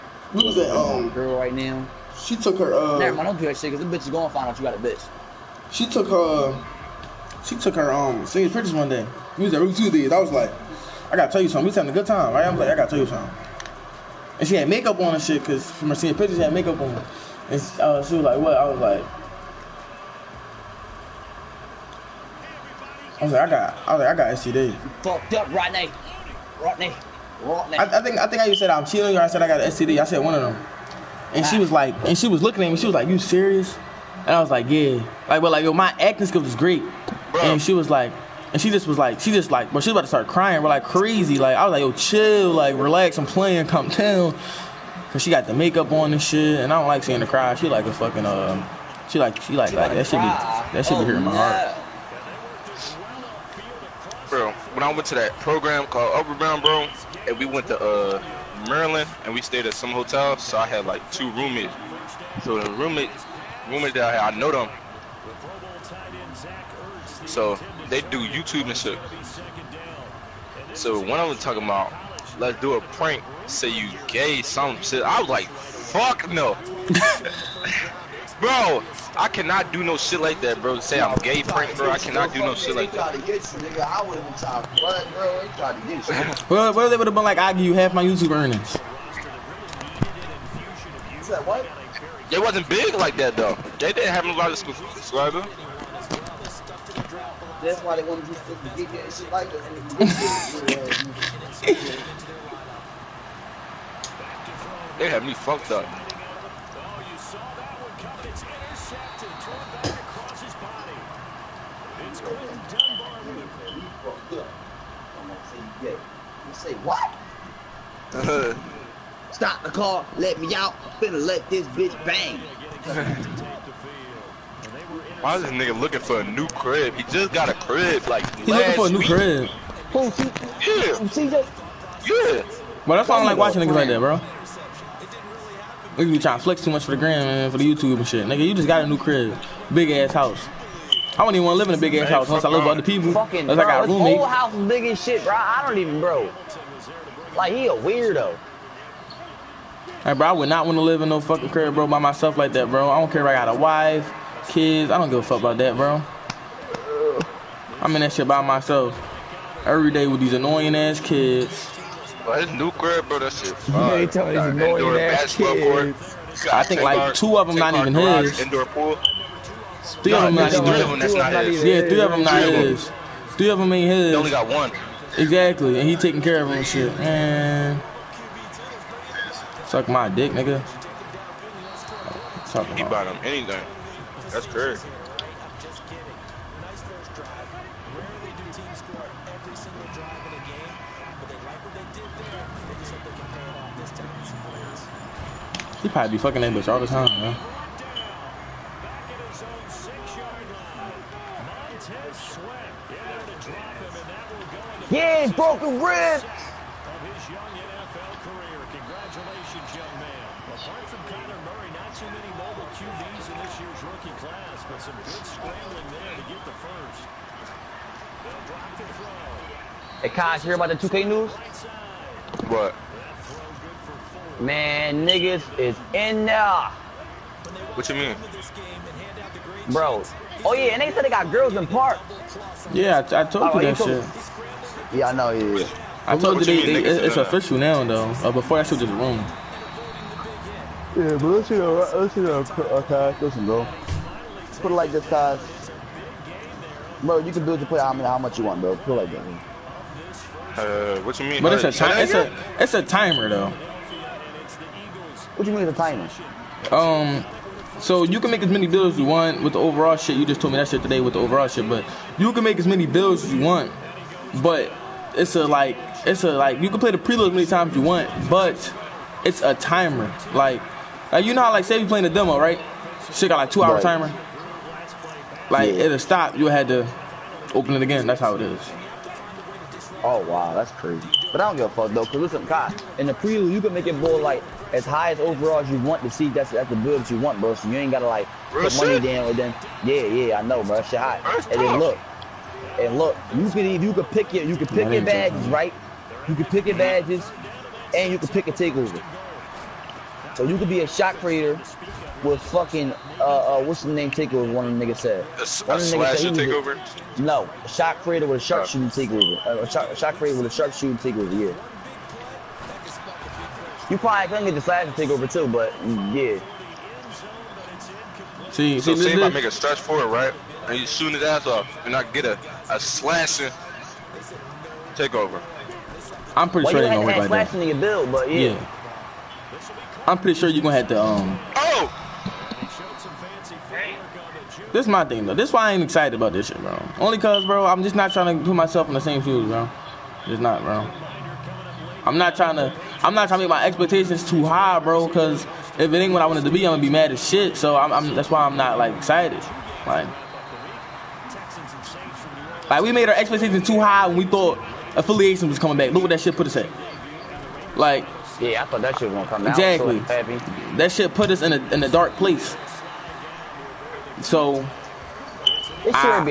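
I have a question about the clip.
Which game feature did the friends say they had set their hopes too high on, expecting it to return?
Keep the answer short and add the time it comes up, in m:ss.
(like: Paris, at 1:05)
affiliation, at 5:54.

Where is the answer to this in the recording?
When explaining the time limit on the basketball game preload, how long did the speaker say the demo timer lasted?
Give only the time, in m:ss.
4:33.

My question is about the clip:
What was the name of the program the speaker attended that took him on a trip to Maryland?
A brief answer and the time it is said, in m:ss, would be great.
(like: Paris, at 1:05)
Upper Bound, at 0:56.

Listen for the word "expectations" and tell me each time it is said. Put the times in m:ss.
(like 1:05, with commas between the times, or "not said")
5:43, 5:53.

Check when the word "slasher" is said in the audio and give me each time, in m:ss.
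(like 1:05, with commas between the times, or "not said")
5:05, 5:14, 5:22.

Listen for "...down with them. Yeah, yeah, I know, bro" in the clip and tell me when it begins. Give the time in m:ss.
4:48.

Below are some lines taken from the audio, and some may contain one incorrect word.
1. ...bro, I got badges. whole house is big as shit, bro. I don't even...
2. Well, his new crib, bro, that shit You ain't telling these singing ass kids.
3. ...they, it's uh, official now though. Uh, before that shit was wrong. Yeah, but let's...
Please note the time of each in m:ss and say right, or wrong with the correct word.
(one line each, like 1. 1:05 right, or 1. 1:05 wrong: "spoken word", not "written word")
1. 2:23 wrong: "roommates", not "badges"
2. 2:42 wrong: "annoying", not "singing"
3. 3:56 right.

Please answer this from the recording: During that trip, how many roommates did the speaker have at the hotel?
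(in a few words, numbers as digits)
2.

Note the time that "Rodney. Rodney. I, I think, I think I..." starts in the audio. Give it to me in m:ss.
0:26.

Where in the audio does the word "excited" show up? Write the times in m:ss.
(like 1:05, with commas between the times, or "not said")
5:35, 5:48.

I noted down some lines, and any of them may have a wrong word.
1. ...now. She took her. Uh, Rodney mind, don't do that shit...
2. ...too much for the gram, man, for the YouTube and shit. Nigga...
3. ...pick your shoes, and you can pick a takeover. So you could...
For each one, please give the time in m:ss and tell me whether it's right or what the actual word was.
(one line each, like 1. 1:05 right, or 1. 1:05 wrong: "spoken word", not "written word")
1. 0:01 wrong: "Never", not "Rodney"
2. 2:16 right
3. 4:56 wrong: "badges", not "shoes".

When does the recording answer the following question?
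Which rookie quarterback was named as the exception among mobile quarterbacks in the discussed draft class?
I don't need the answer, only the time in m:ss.
3:31.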